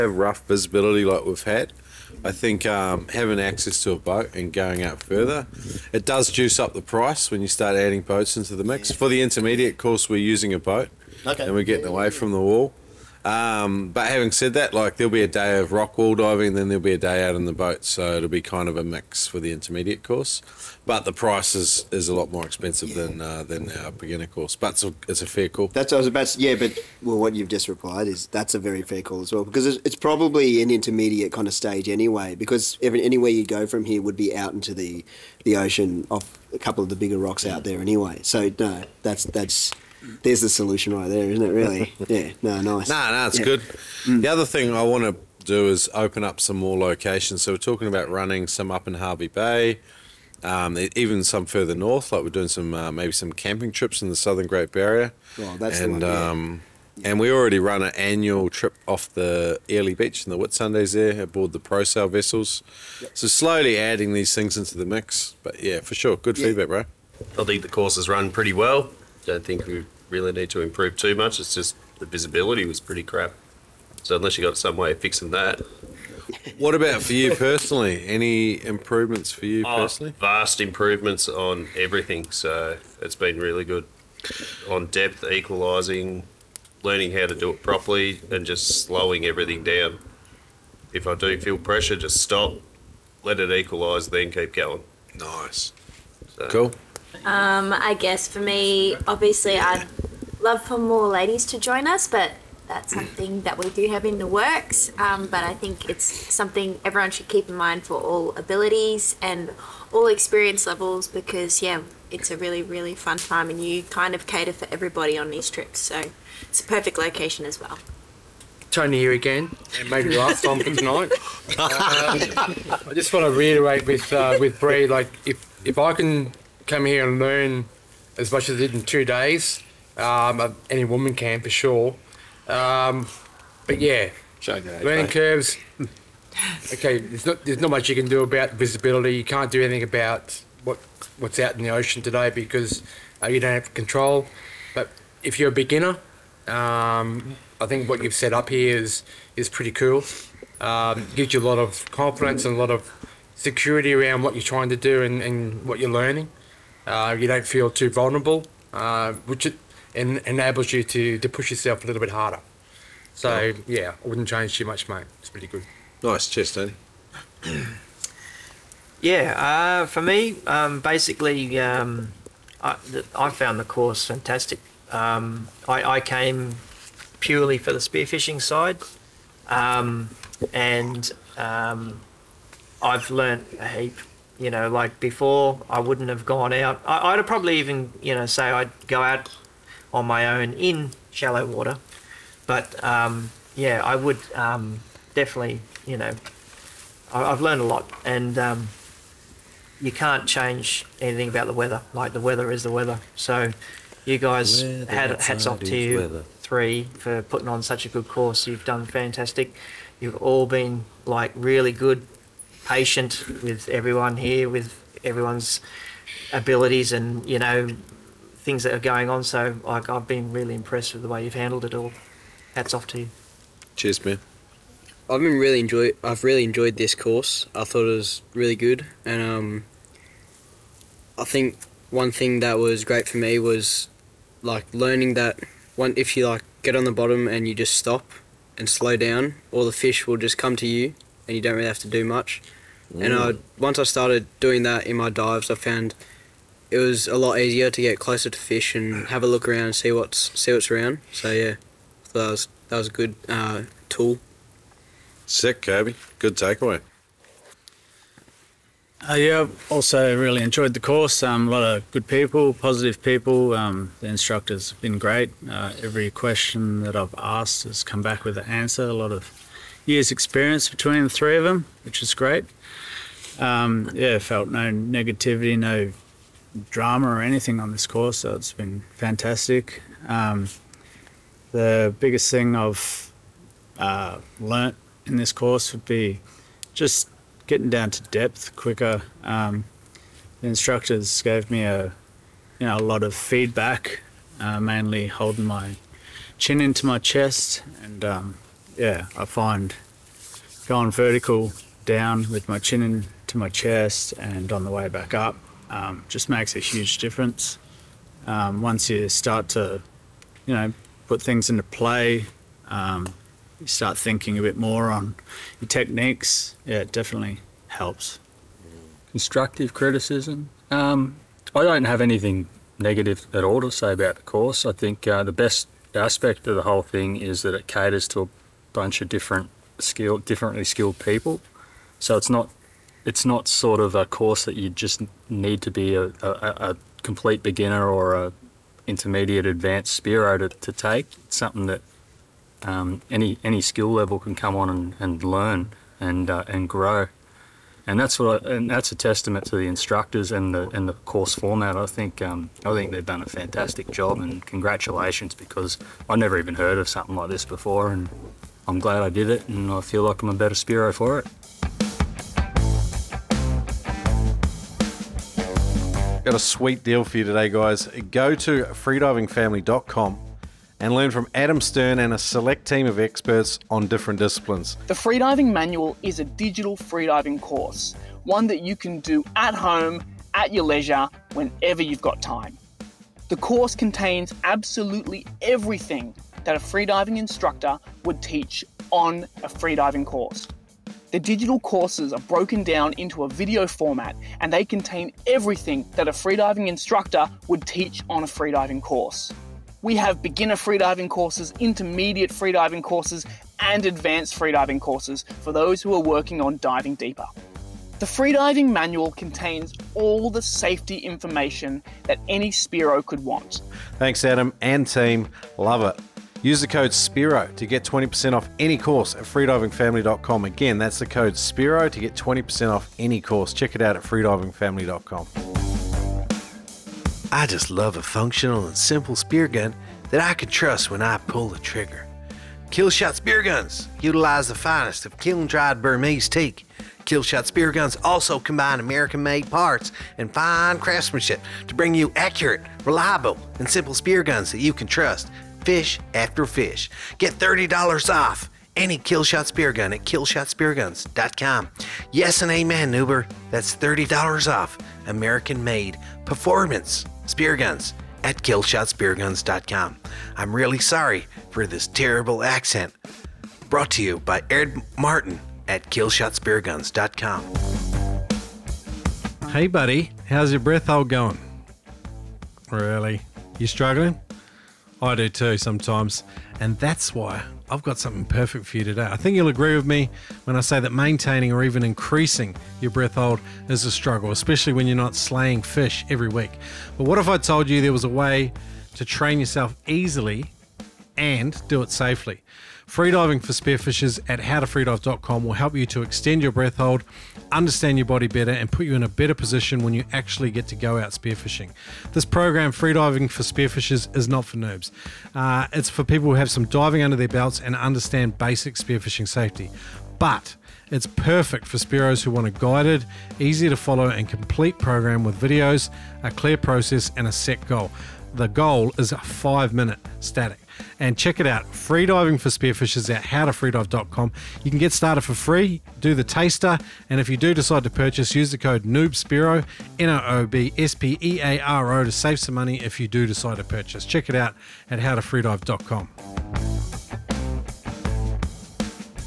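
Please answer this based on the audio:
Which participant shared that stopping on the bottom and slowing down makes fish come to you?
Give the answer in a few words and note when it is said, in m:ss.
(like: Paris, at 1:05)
Kirby, at 4:15.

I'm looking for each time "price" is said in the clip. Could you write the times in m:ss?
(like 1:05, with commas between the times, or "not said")
0:06, 0:21.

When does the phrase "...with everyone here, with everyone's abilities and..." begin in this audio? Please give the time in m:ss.
3:33.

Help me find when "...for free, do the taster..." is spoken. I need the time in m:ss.
8:45.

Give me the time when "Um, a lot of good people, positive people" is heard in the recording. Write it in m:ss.
4:21.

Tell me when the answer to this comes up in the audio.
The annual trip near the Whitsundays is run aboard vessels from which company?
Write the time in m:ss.
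1:01.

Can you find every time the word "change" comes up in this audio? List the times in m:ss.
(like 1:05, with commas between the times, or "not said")
2:44, 3:20.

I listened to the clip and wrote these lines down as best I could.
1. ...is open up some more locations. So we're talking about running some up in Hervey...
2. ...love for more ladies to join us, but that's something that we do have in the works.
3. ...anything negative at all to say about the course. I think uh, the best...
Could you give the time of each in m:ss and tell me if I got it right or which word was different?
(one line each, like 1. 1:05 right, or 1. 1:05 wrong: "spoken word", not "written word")
1. 0:45 right
2. 1:40 right
3. 5:22 right.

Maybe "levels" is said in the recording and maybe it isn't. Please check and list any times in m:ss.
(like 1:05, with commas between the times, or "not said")
1:50, 5:43.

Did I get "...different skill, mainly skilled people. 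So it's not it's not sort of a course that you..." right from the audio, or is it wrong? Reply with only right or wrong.
wrong.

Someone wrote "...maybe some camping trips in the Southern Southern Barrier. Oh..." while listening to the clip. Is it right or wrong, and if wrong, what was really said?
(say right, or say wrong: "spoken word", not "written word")
wrong: "Great", not "Southern".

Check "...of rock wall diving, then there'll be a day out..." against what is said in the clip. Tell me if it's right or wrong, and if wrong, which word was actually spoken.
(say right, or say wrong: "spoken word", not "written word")
right.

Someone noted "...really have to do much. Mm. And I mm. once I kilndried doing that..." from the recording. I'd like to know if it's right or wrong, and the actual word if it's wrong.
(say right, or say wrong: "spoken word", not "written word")
wrong: "started", not "kilndried".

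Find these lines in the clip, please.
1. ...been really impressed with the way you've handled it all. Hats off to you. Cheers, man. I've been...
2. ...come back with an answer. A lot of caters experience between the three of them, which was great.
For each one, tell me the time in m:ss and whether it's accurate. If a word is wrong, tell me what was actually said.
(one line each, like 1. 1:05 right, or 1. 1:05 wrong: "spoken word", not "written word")
1. 3:40 right
2. 4:27 wrong: "years", not "caters".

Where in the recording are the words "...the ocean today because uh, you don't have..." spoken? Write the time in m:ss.
2:21.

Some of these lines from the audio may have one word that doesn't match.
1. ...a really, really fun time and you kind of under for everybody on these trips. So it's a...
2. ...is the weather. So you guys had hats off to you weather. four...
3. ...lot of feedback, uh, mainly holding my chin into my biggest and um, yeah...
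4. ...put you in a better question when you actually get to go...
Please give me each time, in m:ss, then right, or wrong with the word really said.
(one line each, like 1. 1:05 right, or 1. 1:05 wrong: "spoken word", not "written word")
1. 1:52 wrong: "cater", not "under"
2. 3:22 wrong: "three", not "four"
3. 4:52 wrong: "chest", not "biggest"
4. 8:18 wrong: "position", not "question".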